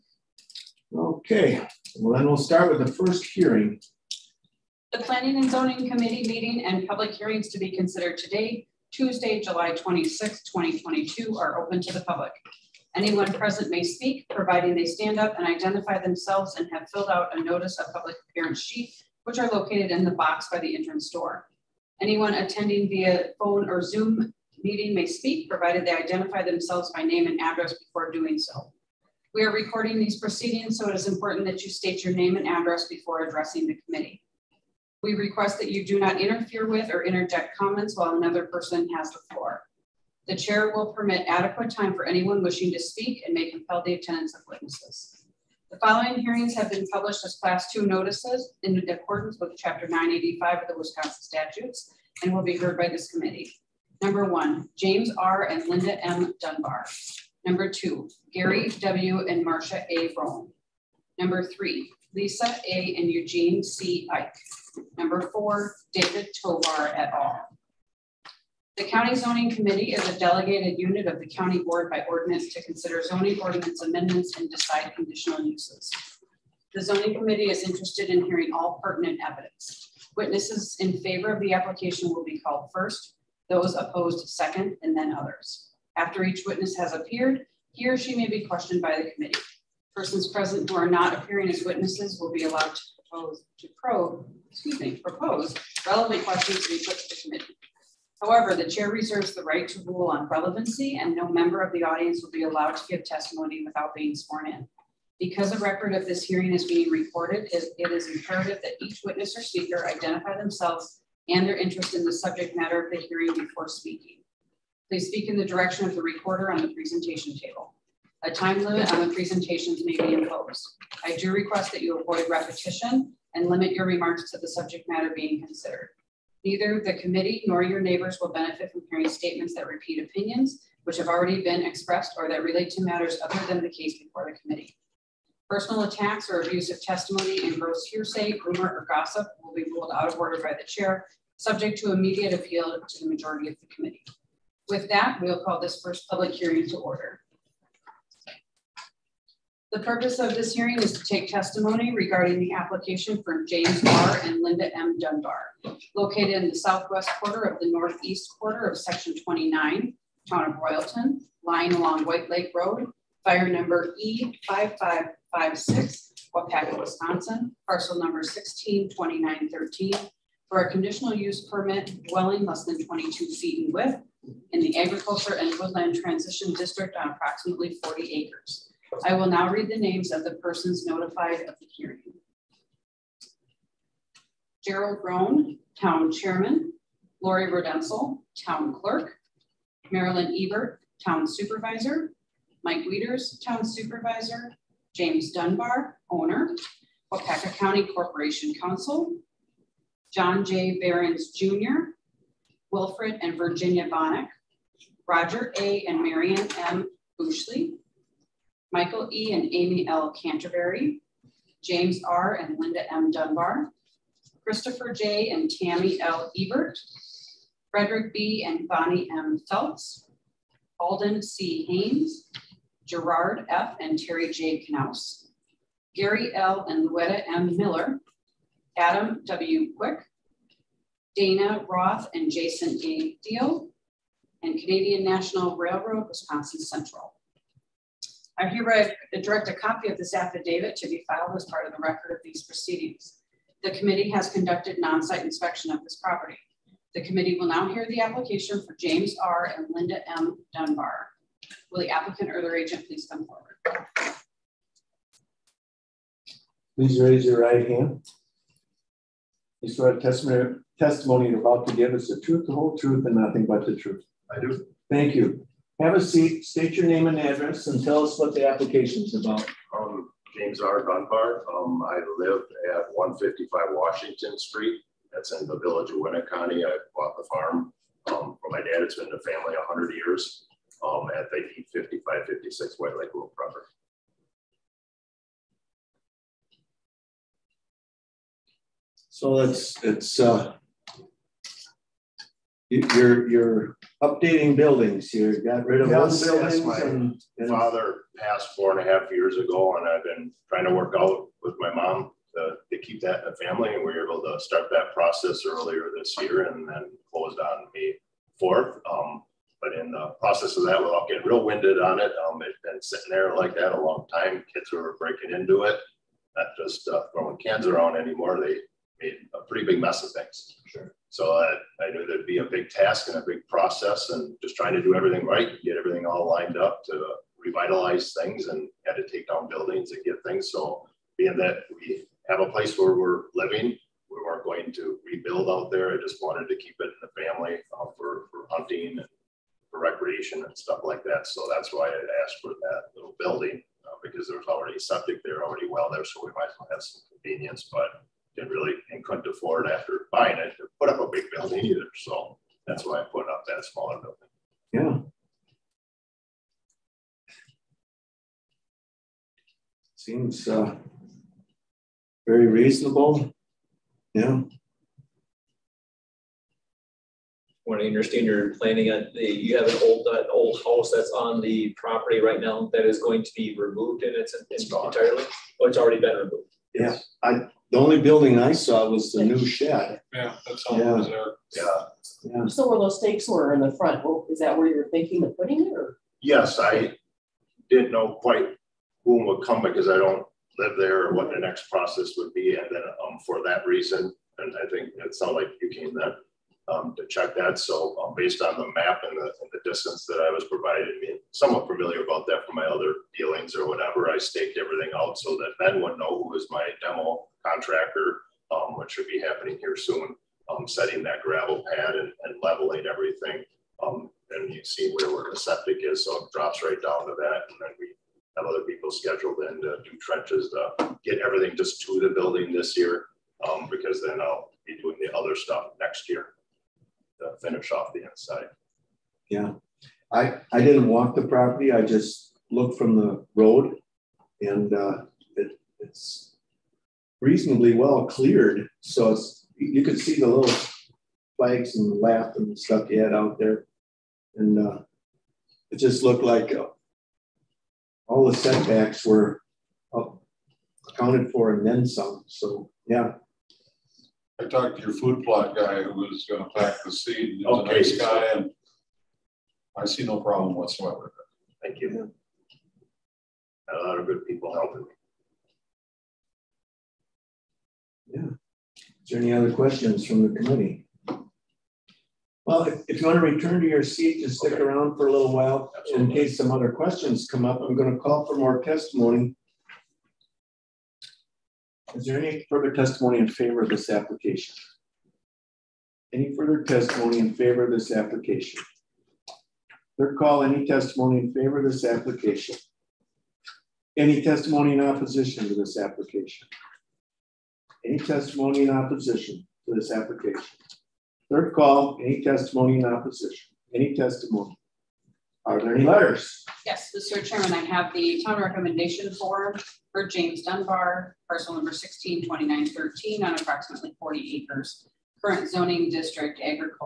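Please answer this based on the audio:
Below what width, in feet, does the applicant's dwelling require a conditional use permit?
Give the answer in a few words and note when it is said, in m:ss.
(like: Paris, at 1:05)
22 feet, at 2:52.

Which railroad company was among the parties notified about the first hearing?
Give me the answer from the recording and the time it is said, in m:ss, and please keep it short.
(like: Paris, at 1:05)
Canadian National Railroad, at 3:54.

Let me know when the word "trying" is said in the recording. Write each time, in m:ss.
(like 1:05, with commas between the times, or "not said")
5:00, 5:24.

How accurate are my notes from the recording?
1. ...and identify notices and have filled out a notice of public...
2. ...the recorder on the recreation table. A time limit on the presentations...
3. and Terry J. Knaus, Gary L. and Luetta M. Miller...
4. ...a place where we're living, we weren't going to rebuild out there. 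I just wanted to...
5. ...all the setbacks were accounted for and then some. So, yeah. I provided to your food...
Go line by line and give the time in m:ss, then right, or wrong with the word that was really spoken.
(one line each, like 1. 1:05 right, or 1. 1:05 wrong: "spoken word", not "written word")
1. 0:15 wrong: "themselves", not "notices"
2. 1:55 wrong: "presentation", not "recreation"
3. 3:43 right
4. 5:32 right
5. 7:28 wrong: "talked", not "provided".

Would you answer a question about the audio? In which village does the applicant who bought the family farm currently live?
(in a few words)
Winneconne.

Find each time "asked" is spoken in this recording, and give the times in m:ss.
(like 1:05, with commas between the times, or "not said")
5:42.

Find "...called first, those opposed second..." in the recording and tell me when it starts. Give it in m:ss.
1:22.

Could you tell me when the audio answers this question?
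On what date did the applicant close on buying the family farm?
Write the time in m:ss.
5:07.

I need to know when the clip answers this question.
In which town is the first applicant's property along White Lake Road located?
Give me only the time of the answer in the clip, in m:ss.
2:40.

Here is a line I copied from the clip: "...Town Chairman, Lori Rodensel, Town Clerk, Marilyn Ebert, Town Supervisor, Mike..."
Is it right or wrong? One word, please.
right.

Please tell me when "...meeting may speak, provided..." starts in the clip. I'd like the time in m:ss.
0:24.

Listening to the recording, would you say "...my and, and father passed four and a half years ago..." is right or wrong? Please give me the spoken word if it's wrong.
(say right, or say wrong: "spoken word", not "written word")
right.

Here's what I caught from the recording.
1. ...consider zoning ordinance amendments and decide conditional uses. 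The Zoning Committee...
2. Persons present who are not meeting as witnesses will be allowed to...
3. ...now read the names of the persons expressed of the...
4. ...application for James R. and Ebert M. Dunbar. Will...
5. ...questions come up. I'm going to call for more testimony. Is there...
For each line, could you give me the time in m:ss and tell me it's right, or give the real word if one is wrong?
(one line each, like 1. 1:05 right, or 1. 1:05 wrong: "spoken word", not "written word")
1. 1:12 right
2. 1:29 wrong: "appearing", not "meeting"
3. 2:59 wrong: "notified", not "expressed"
4. 4:07 wrong: "Linda", not "Ebert"
5. 7:56 right.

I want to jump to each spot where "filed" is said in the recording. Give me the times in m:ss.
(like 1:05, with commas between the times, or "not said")
4:01.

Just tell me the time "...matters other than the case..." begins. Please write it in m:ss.
2:12.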